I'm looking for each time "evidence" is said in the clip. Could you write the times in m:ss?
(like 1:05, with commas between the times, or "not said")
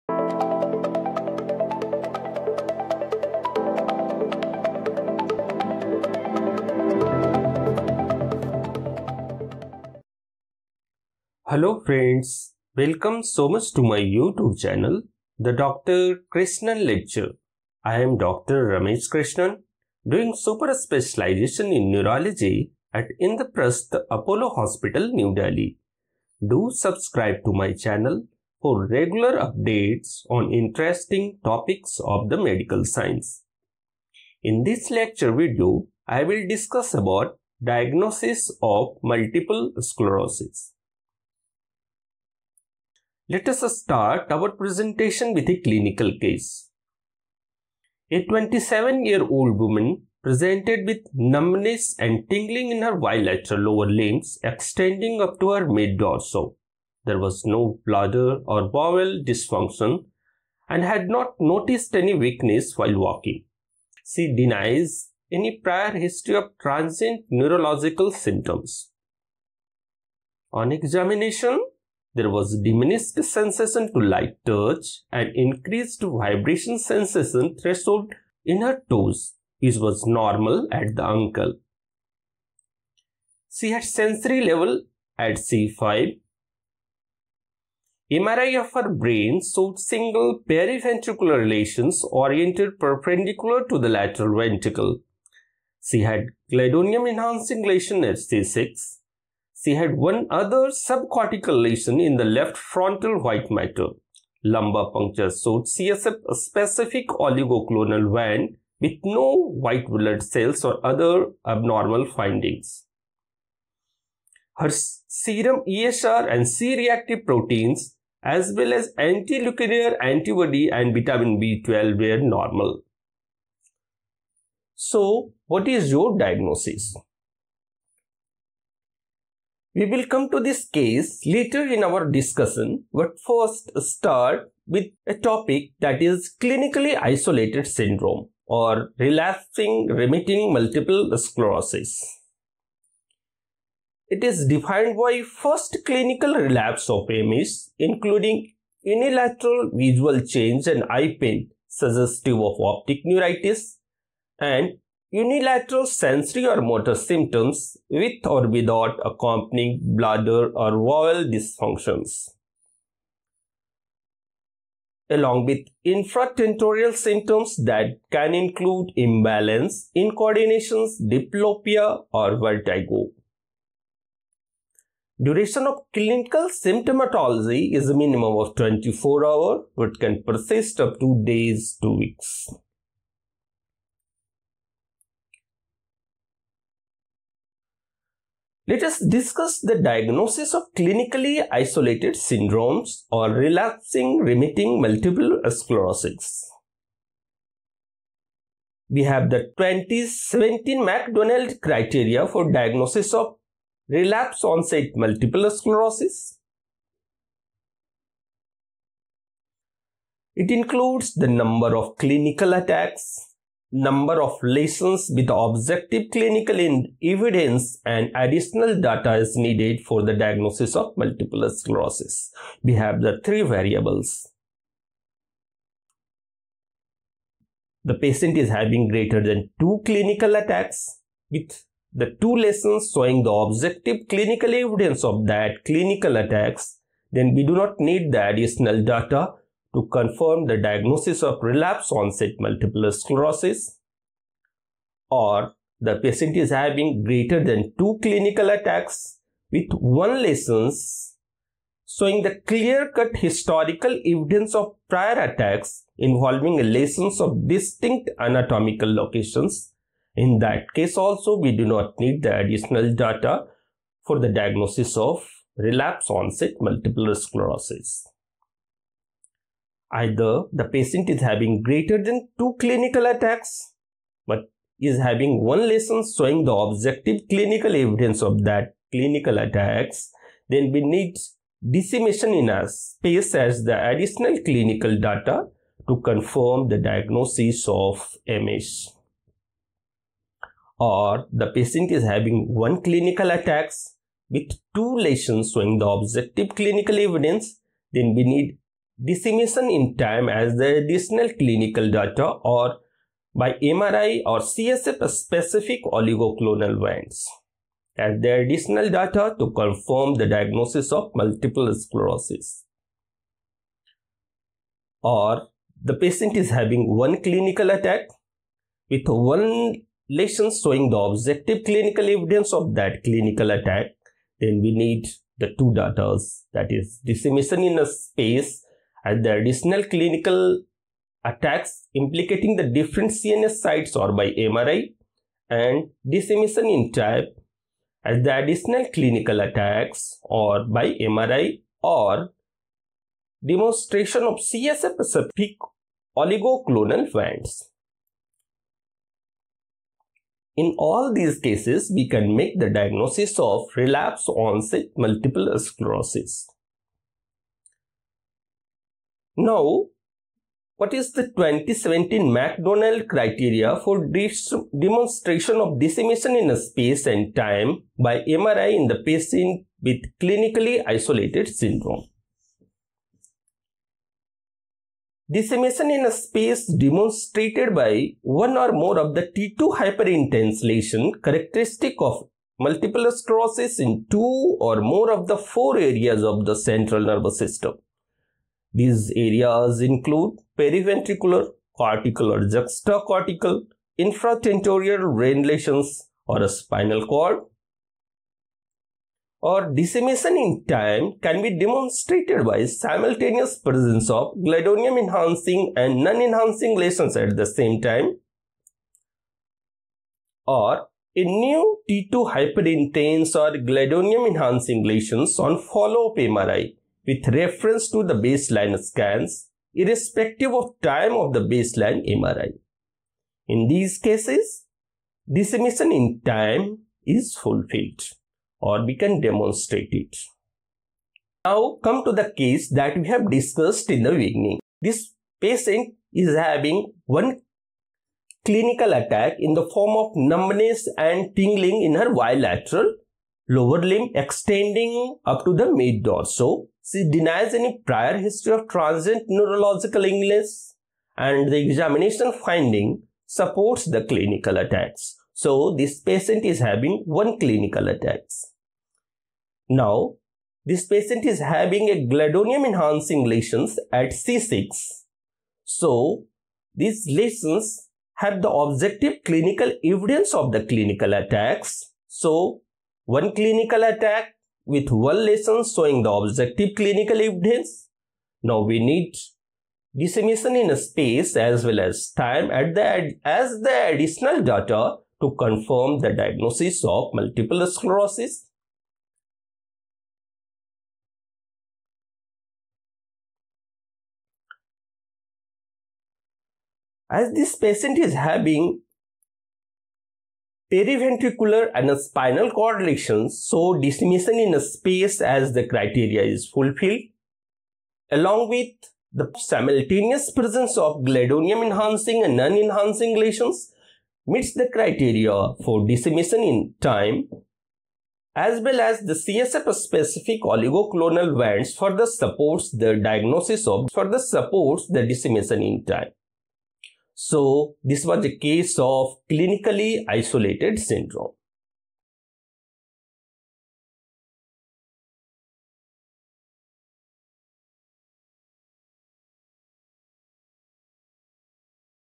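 3:37, 3:54, 4:14, 4:37, 4:56, 5:22, 7:49, 7:57.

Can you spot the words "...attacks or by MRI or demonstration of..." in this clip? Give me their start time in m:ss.
5:39.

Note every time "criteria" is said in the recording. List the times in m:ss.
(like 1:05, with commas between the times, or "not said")
3:21, 6:03, 8:25, 8:34.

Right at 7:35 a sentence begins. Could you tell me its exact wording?
So this patient is having one clinical attacks.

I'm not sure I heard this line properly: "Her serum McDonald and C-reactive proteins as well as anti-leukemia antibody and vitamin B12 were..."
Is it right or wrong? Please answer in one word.
wrong.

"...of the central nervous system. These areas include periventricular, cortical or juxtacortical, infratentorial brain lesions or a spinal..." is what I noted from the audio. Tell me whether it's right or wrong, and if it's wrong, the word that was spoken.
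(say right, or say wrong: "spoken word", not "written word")
right.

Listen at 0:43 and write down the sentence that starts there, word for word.
Let us start our presentation with a clinical case.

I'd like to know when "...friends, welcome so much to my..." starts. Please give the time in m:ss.
0:11.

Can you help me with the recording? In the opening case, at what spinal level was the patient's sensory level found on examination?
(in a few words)
C5.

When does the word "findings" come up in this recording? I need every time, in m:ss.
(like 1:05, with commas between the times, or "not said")
1:52, 7:32.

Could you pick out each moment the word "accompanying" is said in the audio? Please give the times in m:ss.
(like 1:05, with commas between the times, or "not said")
2:39.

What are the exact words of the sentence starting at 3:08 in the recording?
Let us discuss the diagnosis of clinically isolated syndromes or relapsing remitting multiple sclerosis.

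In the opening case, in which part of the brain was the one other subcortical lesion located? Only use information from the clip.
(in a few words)
left frontal white matter.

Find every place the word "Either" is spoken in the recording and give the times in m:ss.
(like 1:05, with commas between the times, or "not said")
4:29.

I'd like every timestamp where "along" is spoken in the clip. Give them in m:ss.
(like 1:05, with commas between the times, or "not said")
2:45, 8:28.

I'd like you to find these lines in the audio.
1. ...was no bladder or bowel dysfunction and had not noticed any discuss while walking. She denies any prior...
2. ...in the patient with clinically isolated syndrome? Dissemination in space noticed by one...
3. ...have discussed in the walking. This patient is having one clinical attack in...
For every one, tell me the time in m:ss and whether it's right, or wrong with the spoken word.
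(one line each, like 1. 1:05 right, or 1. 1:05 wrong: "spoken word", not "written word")
1. 0:57 wrong: "weakness", not "discuss"
2. 6:08 wrong: "demonstrated", not "noticed"
3. 7:13 wrong: "beginning", not "walking".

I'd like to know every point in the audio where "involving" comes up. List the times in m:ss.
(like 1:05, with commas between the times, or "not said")
4:15.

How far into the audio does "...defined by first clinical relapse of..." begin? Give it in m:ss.
2:24.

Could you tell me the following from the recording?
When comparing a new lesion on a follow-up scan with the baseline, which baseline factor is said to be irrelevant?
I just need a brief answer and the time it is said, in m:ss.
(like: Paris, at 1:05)
time of the baseline MRI, at 7:00.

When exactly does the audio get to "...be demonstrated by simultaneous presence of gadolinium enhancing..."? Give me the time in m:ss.
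6:41.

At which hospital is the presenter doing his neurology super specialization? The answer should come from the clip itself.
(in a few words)
Indraprasth Apollo Hospital.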